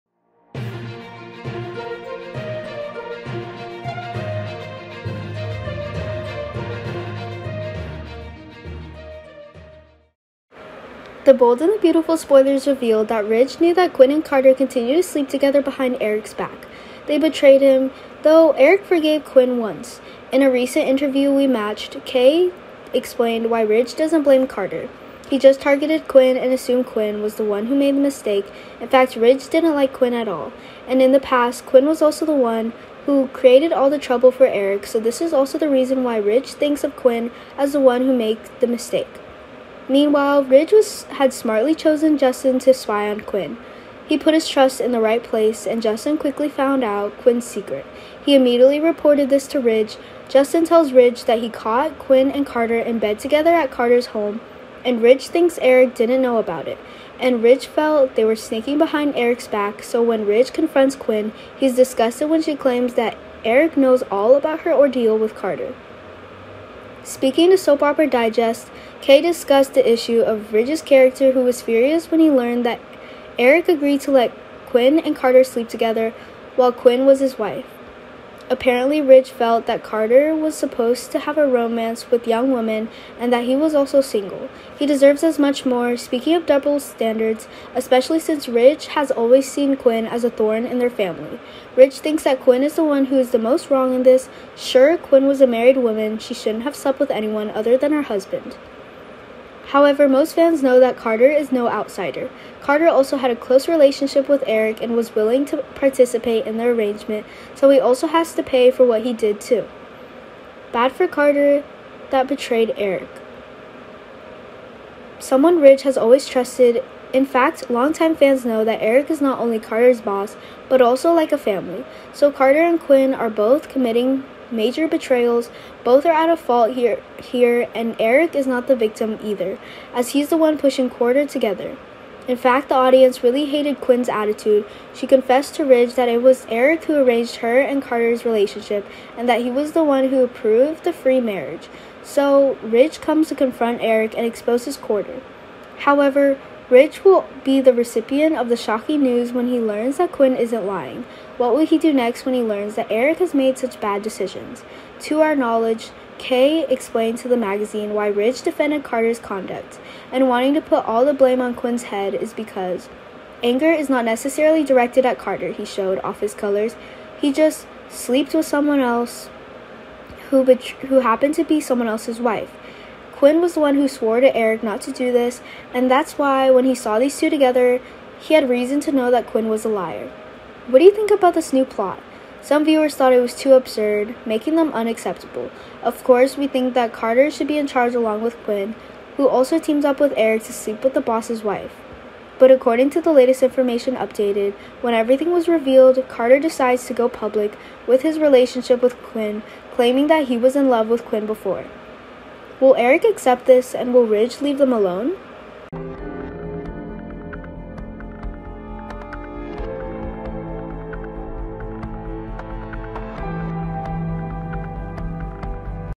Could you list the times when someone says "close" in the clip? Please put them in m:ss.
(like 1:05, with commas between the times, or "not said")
1:43.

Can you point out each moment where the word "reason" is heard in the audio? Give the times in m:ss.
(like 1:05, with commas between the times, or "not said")
0:35, 2:58.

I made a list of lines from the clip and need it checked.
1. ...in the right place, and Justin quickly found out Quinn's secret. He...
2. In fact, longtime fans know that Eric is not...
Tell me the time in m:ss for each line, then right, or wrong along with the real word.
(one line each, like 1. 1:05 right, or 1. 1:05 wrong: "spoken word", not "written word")
1. 0:44 right
2. 1:57 right.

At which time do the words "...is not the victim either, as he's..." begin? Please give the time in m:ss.
2:08.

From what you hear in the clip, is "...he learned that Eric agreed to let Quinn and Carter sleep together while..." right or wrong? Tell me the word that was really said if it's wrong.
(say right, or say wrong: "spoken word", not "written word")
right.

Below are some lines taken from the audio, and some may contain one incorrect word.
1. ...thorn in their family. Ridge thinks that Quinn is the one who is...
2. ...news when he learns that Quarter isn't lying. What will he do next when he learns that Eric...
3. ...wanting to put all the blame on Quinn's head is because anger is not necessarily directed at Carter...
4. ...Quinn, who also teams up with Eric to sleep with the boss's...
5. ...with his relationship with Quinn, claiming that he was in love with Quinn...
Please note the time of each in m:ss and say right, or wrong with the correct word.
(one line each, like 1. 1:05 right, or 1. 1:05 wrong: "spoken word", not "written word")
1. 1:30 right
2. 2:29 wrong: "Quinn", not "Quarter"
3. 2:40 right
4. 3:08 right
5. 3:17 right.